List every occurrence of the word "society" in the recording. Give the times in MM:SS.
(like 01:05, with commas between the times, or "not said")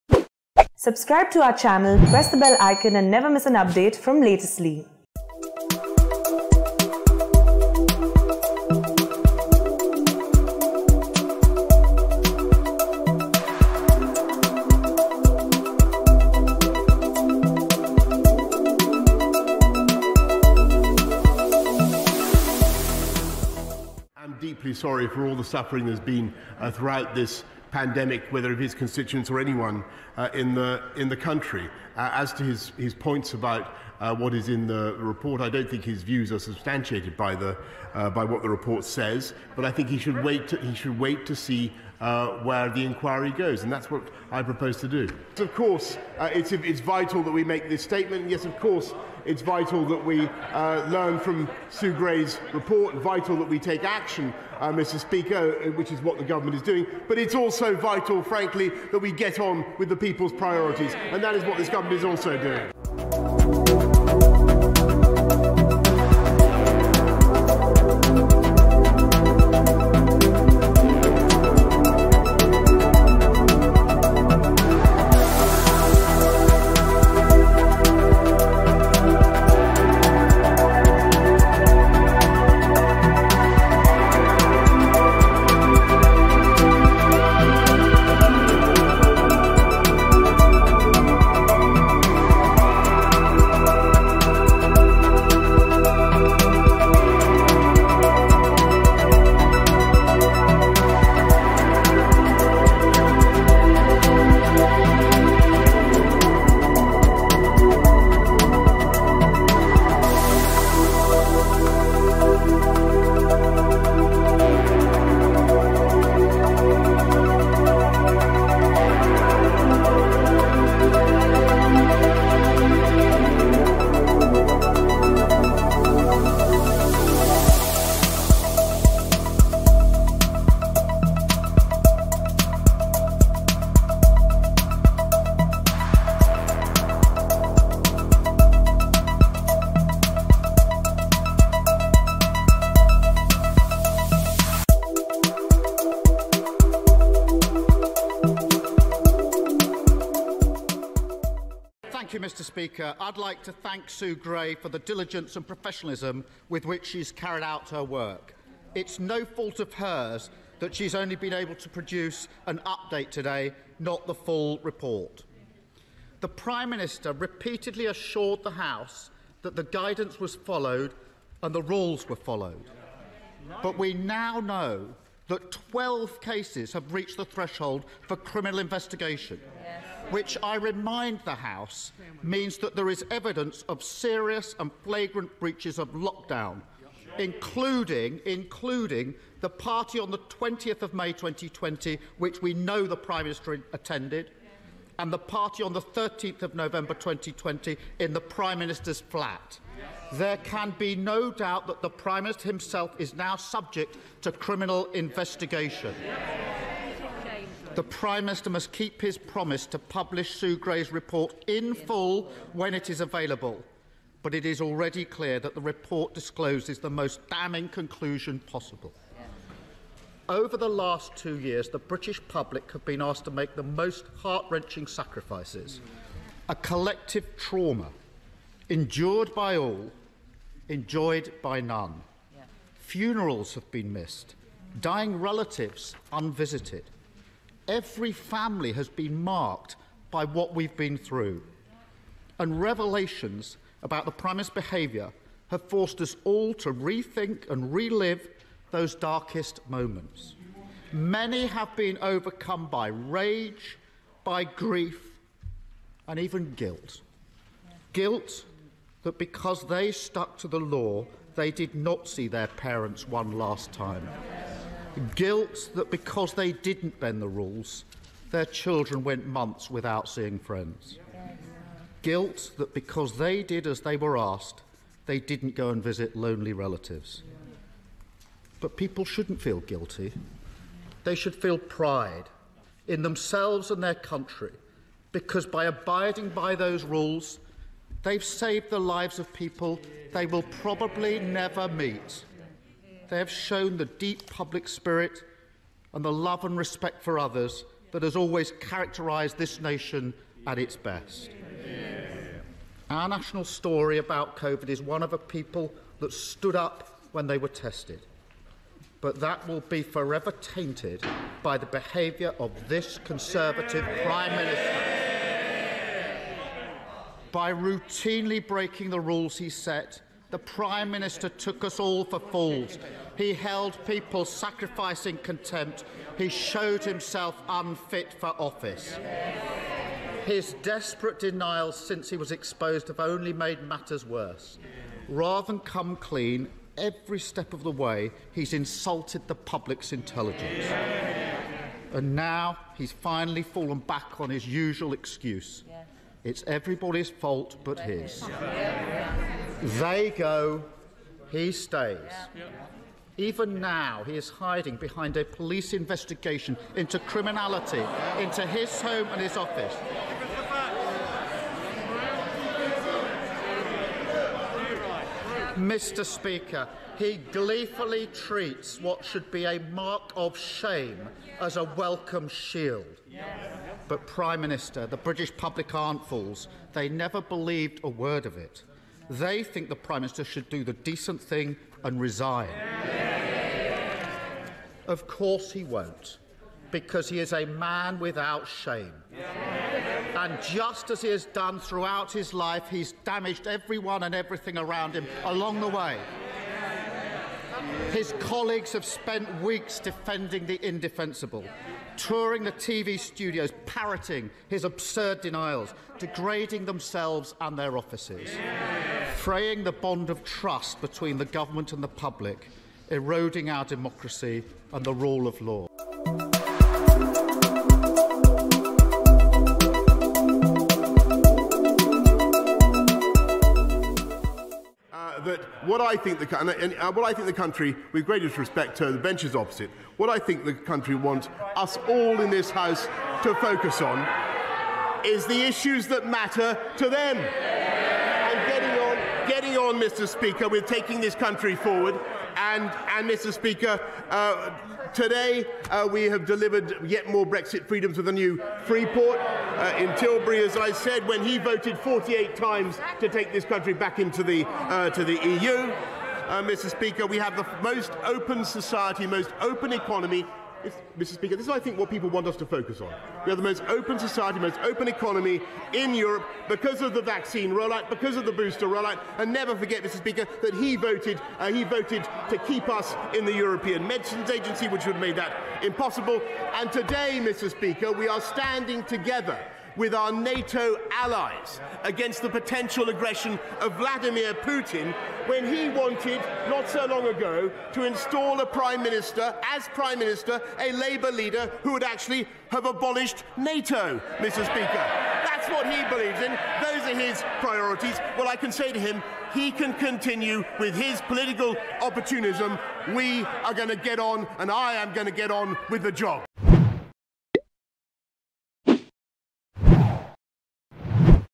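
07:38, 07:43.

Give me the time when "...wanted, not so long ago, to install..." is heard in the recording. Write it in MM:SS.
08:05.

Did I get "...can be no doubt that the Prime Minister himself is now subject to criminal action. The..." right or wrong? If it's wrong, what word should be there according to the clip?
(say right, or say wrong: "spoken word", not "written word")
wrong: "investigation", not "action".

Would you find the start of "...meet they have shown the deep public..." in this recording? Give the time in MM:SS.
04:51.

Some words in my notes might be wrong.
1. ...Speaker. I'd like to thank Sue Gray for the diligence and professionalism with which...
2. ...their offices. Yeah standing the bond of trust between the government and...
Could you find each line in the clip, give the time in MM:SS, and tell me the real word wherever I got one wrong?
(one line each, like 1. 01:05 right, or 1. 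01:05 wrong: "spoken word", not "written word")
1. 02:32 right
2. 06:47 wrong: "fraying", not "standing".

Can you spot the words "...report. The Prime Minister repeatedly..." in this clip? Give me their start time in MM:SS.
02:44.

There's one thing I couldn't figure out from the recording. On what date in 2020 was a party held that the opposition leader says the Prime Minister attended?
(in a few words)
20 May 2020.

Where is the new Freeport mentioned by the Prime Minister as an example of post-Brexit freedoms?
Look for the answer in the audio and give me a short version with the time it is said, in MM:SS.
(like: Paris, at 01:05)
Tilbury, at 07:29.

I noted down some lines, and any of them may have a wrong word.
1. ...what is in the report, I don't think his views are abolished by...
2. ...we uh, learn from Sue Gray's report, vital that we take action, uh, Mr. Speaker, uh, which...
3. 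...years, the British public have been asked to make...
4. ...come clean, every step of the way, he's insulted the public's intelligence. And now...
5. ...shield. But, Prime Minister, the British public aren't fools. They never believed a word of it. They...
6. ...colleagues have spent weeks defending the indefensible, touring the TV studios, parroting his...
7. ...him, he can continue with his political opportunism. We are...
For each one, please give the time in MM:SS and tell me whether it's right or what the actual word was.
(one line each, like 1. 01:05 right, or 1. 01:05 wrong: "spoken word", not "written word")
1. 00:34 wrong: "substantiated", not "abolished"
2. 00:50 right
3. 03:41 right
4. 05:35 right
5. 06:12 right
6. 06:38 right
7. 08:18 right.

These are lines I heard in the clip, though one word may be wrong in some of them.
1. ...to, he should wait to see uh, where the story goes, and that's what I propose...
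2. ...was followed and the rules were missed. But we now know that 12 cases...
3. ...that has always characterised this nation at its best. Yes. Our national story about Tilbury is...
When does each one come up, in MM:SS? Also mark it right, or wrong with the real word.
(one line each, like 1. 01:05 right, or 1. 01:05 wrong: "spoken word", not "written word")
1. 00:40 wrong: "inquiry", not "story"
2. 02:50 wrong: "followed", not "missed"
3. 04:57 wrong: "COVID", not "Tilbury".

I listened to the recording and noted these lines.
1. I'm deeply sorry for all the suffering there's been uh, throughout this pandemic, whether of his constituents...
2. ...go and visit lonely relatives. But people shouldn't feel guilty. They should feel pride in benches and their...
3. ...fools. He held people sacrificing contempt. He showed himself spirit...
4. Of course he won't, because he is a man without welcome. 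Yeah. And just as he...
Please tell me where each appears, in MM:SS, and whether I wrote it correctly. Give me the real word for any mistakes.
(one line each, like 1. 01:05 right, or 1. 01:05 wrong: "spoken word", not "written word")
1. 00:24 right
2. 04:35 wrong: "themselves", not "benches"
3. 05:22 wrong: "unfit", not "spirit"
4. 06:24 wrong: "shame", not "welcome".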